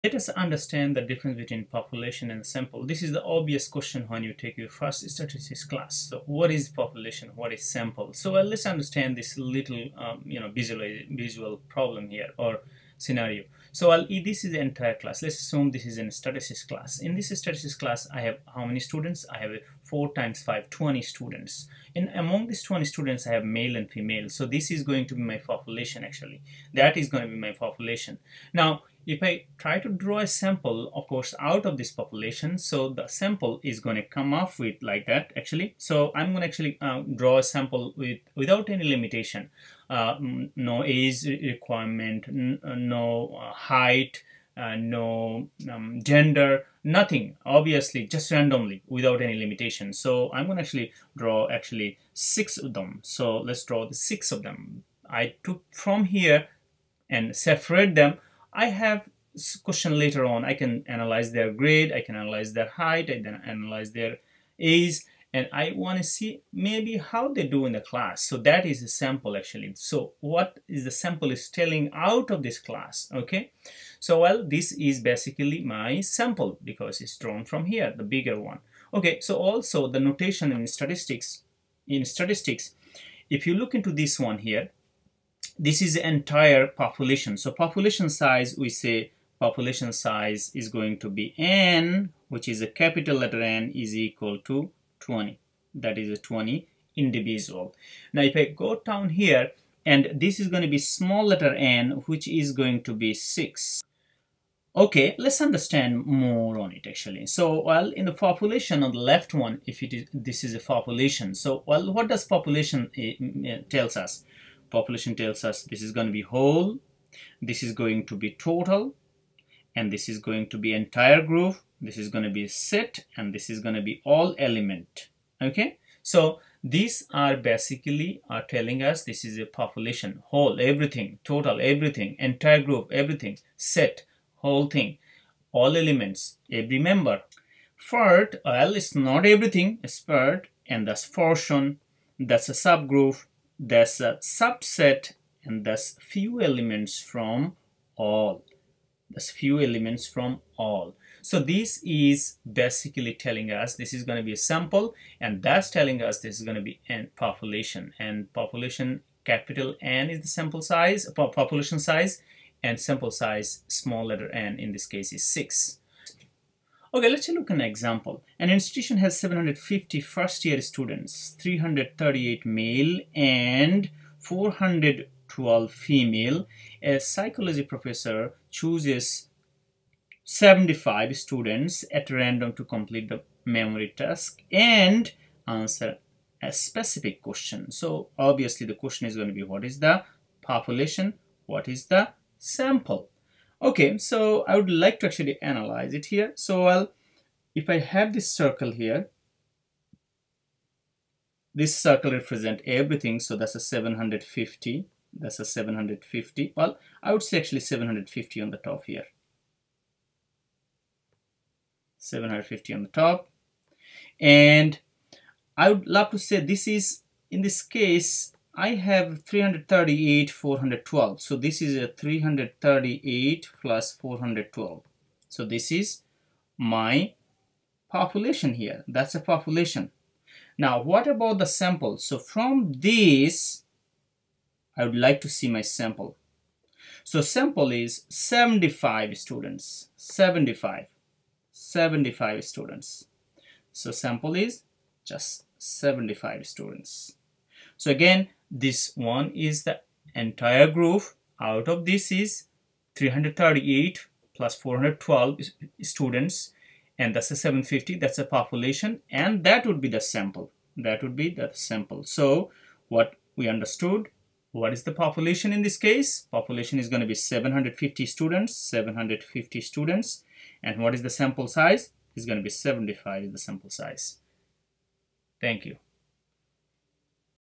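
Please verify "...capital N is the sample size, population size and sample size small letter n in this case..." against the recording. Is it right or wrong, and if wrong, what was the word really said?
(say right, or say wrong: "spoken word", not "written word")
right.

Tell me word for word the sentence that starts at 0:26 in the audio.
That is going to be my population.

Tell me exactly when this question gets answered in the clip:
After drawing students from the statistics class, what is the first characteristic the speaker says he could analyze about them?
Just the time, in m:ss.
1:01.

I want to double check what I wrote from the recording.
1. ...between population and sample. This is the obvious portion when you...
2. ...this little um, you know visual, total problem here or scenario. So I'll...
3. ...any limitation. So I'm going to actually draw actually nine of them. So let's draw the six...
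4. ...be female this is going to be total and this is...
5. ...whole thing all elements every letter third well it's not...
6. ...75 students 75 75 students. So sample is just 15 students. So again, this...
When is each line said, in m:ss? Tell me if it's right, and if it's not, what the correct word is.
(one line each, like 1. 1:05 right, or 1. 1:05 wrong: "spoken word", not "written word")
1. 0:01 wrong: "question", not "portion"
2. 0:09 wrong: "visual", not "total"
3. 0:49 wrong: "six", not "nine"
4. 1:56 wrong: "whole", not "female"
5. 2:14 wrong: "member", not "letter"
6. 3:58 wrong: "75", not "15".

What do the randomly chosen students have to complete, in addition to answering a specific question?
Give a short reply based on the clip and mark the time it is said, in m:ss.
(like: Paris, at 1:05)
memory task, at 3:03.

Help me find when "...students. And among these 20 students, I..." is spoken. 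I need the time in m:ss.
0:21.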